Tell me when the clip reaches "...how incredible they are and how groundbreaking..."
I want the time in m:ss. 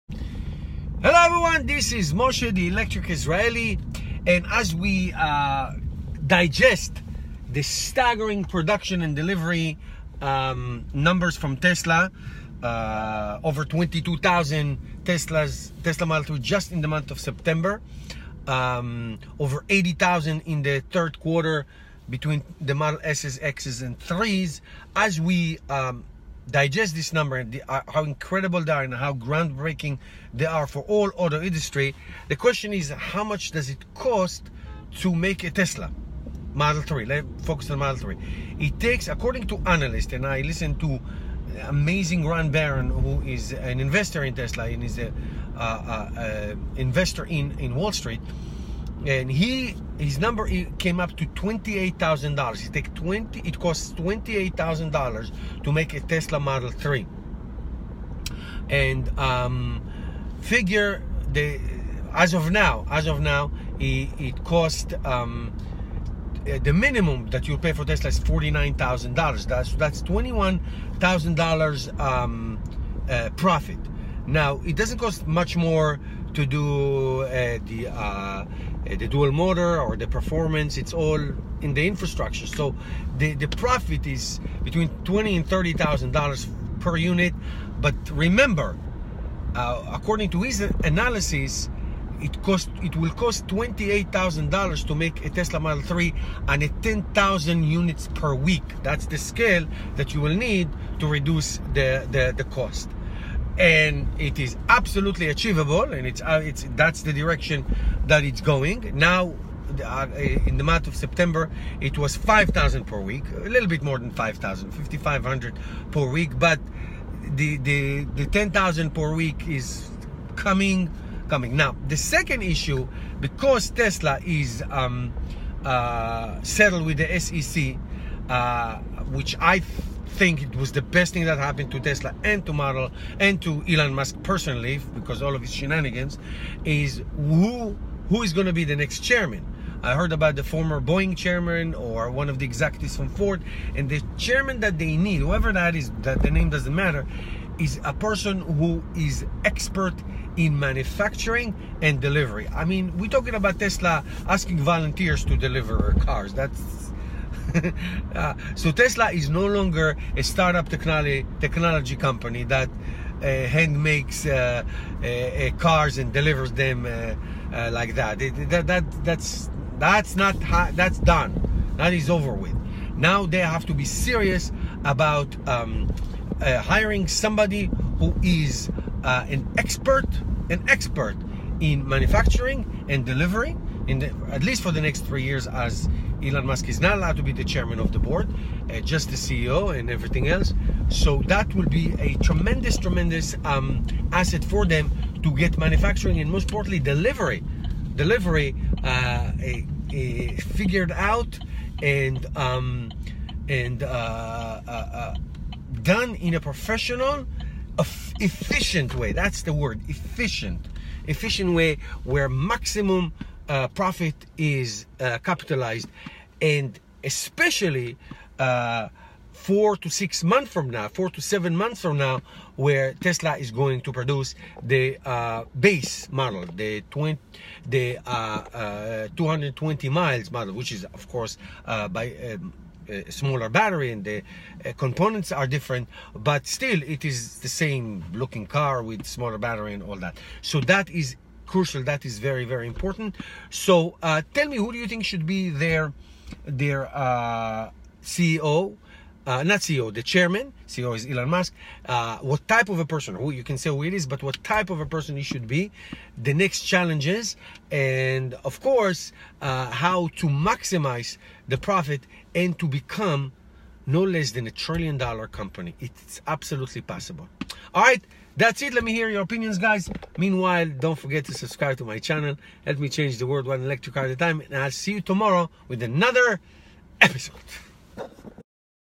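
0:27.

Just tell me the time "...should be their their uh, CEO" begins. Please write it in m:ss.
4:05.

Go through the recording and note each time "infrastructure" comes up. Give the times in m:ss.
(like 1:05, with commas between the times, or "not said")
1:21.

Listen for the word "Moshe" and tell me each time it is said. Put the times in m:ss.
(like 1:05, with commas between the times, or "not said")
0:02.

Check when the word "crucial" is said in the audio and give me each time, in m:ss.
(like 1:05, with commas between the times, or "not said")
4:01.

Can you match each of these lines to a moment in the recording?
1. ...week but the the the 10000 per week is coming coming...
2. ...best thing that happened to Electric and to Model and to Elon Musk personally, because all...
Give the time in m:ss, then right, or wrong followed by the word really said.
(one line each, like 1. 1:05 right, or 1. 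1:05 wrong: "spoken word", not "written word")
1. 1:56 right
2. 2:10 wrong: "Tesla", not "Electric".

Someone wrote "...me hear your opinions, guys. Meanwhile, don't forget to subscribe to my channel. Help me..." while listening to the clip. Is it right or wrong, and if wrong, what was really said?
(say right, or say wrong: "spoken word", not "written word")
right.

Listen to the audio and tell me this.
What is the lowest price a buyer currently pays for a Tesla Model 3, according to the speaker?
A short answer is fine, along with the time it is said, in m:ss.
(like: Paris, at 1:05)
$49,000, at 1:08.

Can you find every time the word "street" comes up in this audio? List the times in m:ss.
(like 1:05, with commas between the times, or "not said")
0:47.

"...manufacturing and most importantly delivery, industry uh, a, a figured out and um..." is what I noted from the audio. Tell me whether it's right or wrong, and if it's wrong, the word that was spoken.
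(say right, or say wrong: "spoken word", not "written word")
wrong: "delivery", not "industry".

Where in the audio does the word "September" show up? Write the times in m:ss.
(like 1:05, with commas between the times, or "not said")
0:17, 1:50.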